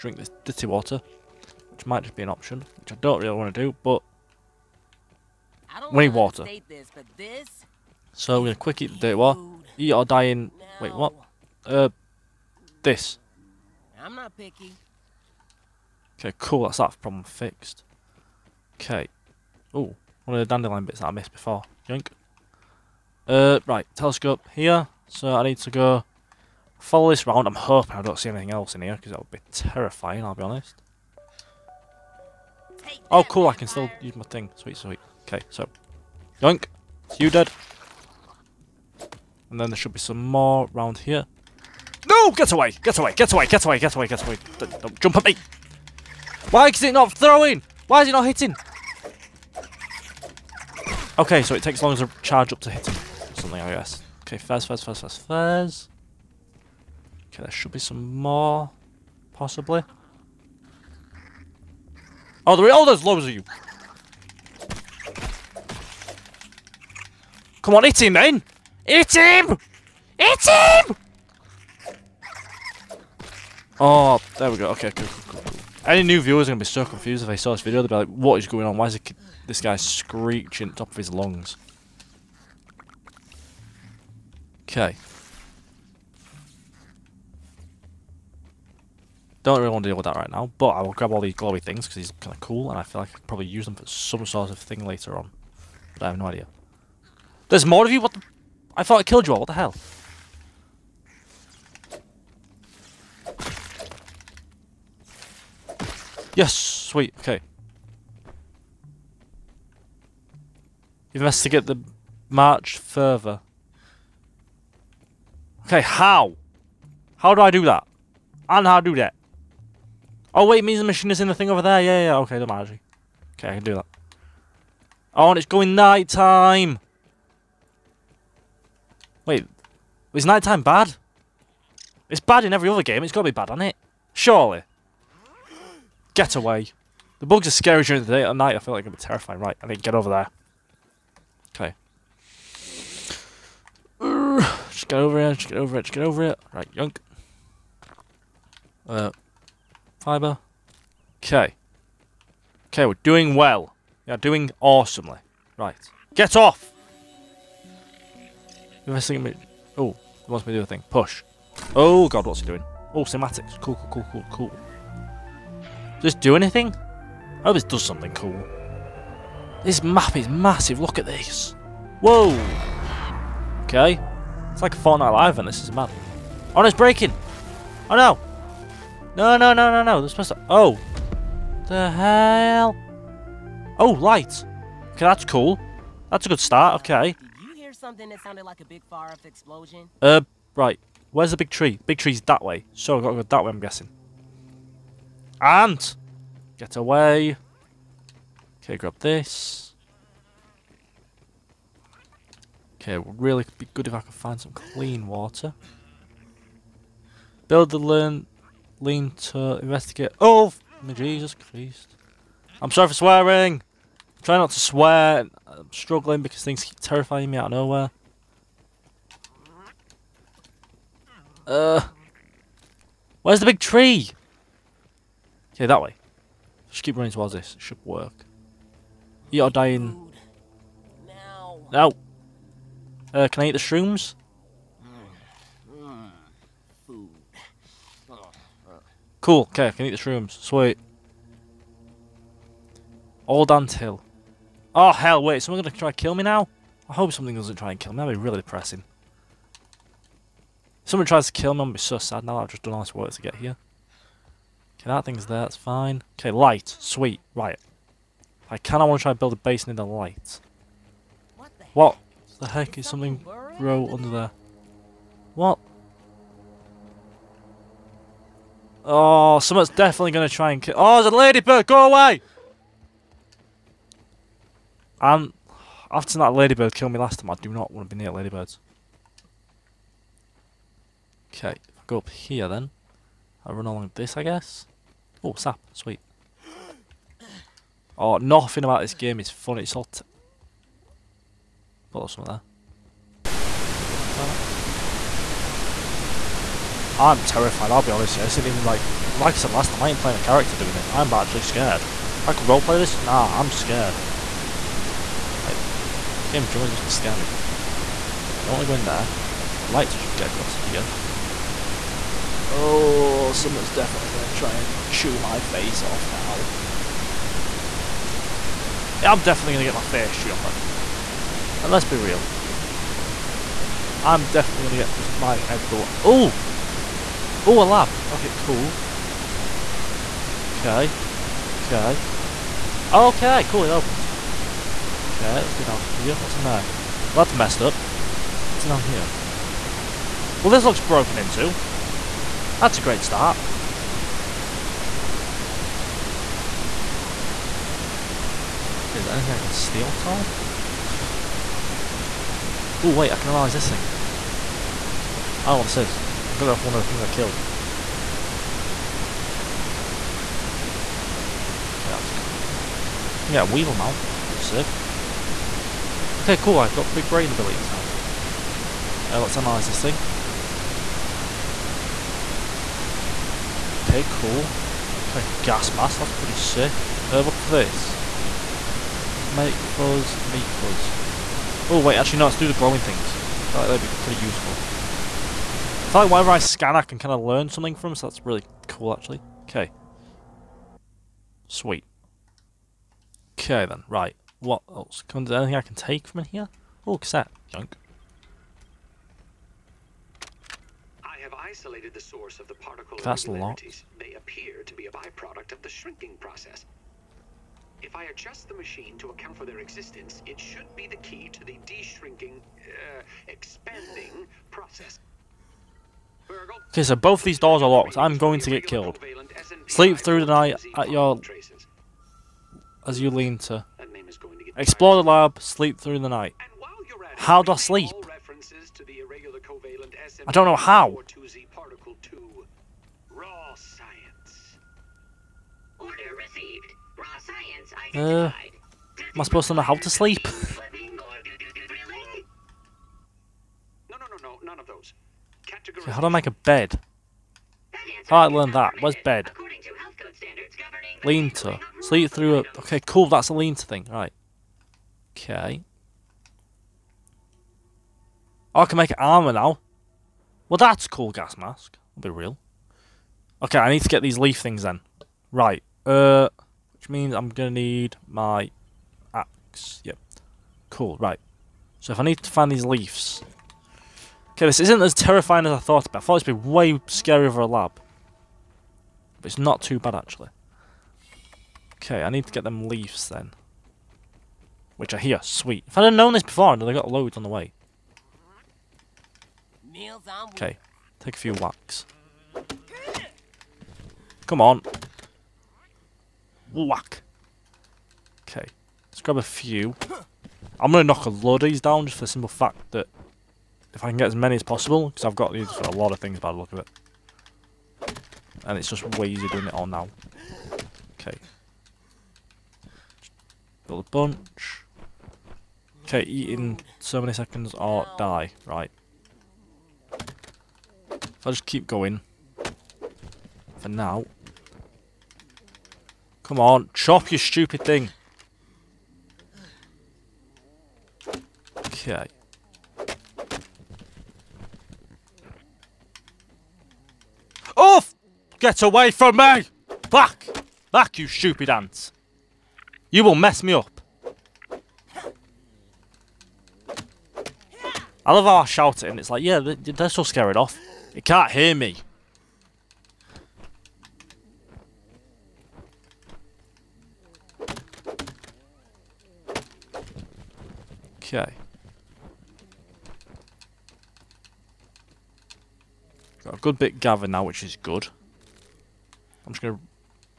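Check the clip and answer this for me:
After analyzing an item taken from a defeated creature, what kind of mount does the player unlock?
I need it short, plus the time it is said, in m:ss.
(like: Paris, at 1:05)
Weevil mount, at 6:03.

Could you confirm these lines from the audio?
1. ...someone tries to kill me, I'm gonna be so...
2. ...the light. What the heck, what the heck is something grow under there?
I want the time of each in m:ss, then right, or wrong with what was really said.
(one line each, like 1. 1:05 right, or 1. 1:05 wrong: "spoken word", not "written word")
1. 4:10 right
2. 4:19 right.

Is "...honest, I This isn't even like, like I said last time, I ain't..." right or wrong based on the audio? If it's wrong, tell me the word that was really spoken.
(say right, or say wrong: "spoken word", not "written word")
right.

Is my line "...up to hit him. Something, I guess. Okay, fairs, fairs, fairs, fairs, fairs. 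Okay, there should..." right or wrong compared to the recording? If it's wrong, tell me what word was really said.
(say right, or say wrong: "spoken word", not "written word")
right.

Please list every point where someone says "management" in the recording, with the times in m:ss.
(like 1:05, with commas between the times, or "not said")
not said.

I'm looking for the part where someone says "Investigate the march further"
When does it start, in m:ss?
1:51.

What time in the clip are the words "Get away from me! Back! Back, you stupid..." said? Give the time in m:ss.
8:58.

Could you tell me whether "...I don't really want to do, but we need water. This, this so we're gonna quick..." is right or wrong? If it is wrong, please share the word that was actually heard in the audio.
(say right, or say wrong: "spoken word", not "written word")
right.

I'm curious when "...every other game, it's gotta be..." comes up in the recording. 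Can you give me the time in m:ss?
2:12.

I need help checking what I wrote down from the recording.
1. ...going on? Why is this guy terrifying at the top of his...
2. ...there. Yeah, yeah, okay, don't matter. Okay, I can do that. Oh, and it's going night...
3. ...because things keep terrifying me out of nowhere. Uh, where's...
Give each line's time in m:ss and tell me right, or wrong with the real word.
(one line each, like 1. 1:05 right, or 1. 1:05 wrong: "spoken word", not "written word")
1. 1:18 wrong: "screeching", not "terrifying"
2. 2:01 right
3. 3:36 right.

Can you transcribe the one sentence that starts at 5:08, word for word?
I don't want to go in there.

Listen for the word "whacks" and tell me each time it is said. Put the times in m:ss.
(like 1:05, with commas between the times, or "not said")
8:11, 8:16.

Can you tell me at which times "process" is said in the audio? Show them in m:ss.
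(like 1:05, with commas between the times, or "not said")
6:46, 6:54.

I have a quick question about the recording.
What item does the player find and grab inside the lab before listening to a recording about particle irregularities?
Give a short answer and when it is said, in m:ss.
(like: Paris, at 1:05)
Cassette, at 6:36.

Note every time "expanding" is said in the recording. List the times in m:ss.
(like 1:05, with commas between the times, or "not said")
6:53.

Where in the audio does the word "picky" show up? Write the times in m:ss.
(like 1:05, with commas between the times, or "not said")
0:14.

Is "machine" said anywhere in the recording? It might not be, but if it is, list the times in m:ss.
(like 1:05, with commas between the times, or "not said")
2:00, 6:48.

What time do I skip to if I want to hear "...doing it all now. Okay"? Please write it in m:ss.
8:29.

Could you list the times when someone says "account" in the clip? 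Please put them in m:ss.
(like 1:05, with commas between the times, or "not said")
6:49.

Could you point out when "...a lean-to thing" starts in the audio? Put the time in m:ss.
7:33.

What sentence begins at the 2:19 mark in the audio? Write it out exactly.
Right, I think get over there.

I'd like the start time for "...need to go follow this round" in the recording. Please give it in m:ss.
0:25.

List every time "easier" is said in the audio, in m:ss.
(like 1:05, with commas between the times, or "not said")
8:29.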